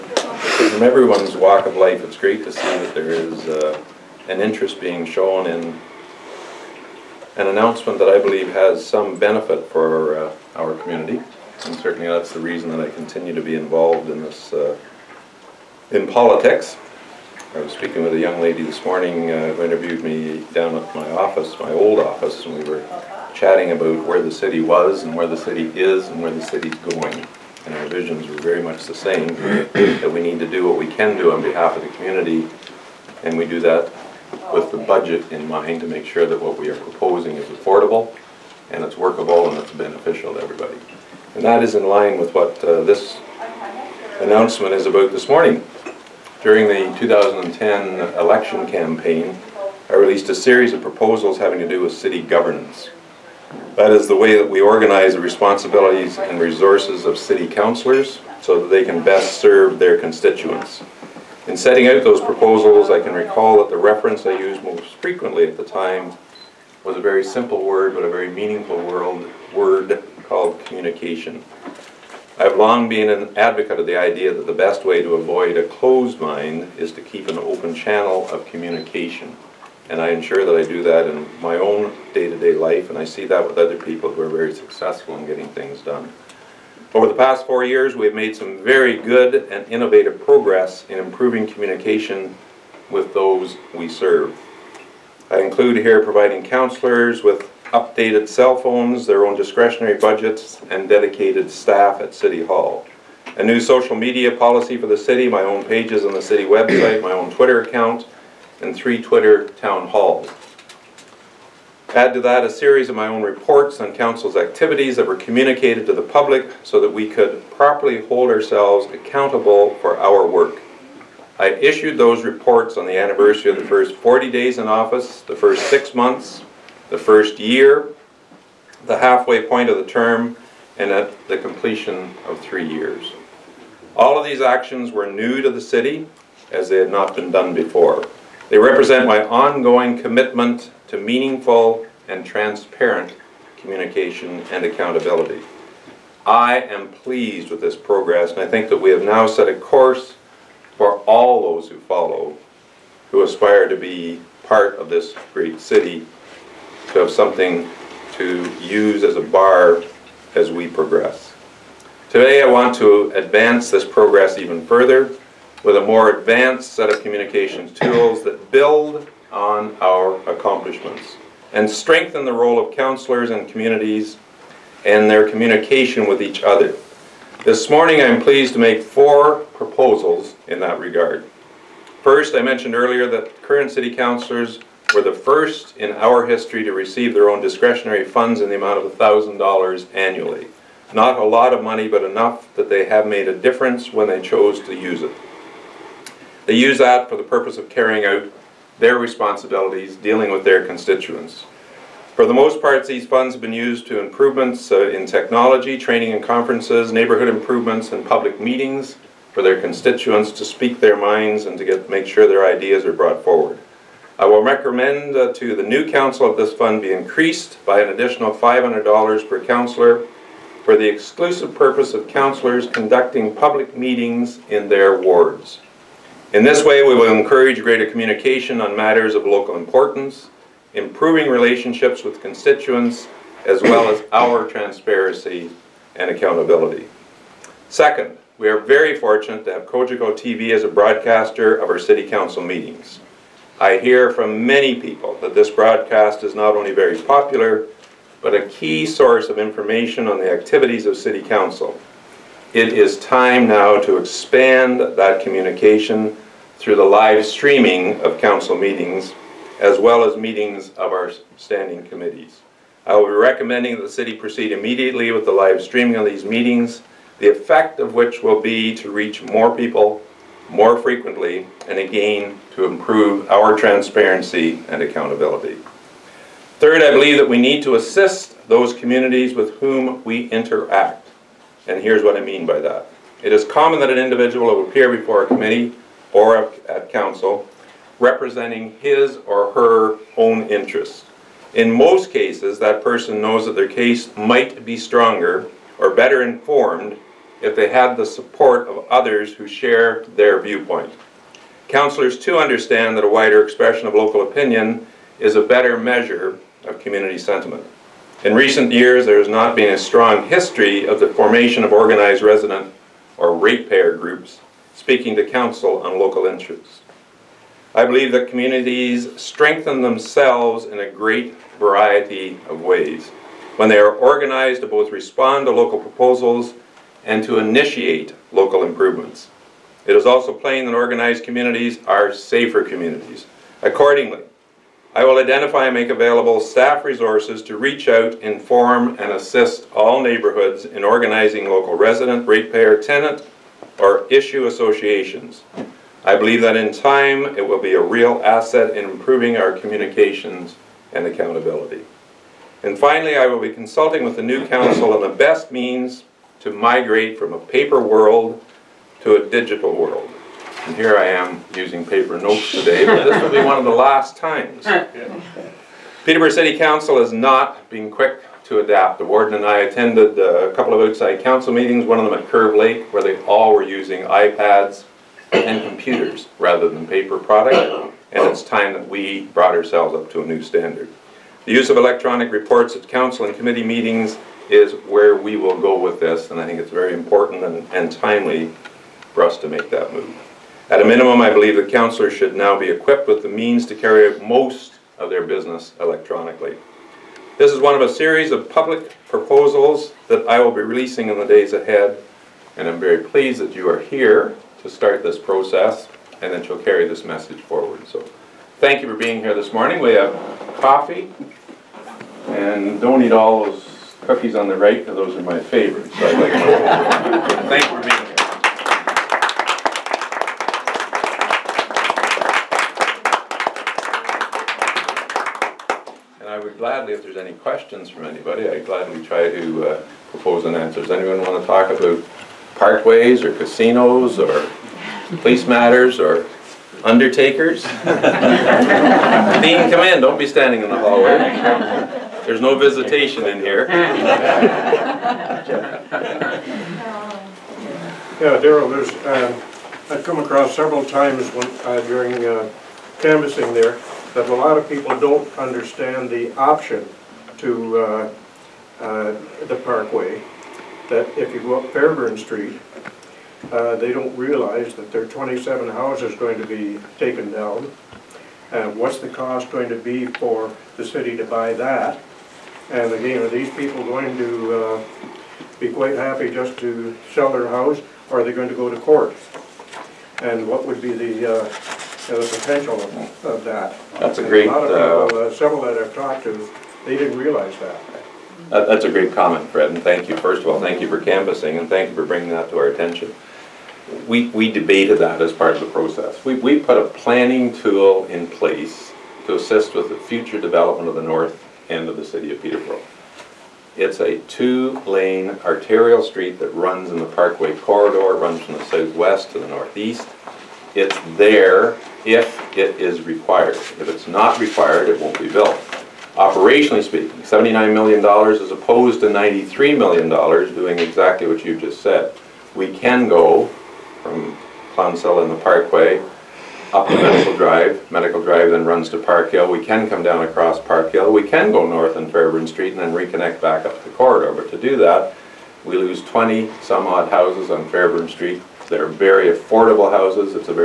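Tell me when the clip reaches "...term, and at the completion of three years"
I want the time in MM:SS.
02:09.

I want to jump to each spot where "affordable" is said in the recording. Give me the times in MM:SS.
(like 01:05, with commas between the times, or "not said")
00:37, 08:59.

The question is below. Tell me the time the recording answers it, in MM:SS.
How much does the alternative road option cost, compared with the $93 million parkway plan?
08:37.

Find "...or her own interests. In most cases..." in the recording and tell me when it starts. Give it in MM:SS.
04:49.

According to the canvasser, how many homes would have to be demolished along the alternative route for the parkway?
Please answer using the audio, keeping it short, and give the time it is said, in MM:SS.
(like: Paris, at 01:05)
27, at 07:45.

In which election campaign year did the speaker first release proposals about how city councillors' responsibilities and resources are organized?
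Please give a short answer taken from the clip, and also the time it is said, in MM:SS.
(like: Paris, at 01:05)
2010, at 00:46.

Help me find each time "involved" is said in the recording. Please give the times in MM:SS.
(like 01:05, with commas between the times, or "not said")
00:13.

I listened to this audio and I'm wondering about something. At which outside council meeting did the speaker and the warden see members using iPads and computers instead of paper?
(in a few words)
Curve Lake.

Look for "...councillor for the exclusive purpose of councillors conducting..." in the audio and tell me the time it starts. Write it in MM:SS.
03:39.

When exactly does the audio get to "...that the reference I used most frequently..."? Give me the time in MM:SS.
01:03.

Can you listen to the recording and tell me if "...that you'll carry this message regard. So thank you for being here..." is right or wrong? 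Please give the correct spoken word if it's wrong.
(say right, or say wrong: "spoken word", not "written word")
wrong: "forward", not "regard".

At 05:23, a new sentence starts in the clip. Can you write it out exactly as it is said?
When they are organized to both respond to local proposals and to initiate local improvements.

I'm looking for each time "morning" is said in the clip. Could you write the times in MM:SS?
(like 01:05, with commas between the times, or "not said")
00:18, 00:45, 02:57, 06:49.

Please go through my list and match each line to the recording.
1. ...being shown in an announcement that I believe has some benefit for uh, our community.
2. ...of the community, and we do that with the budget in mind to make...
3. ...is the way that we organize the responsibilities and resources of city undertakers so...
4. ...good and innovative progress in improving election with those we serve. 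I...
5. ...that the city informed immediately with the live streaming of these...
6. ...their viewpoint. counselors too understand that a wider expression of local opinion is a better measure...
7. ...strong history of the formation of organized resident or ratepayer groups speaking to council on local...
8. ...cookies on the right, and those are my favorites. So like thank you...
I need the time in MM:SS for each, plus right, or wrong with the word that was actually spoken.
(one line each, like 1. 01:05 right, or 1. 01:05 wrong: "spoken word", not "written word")
1. 00:04 right
2. 00:31 right
3. 00:53 wrong: "councilors", not "undertakers"
4. 01:29 wrong: "communication", not "election"
5. 04:23 wrong: "proceed", not "informed"
6. 05:00 right
7. 05:09 right
8. 06:54 right.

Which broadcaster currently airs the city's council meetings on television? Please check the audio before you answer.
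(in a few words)
Cogeco TV.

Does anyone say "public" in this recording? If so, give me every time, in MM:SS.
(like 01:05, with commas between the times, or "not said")
01:56, 03:28, 03:43, 06:38.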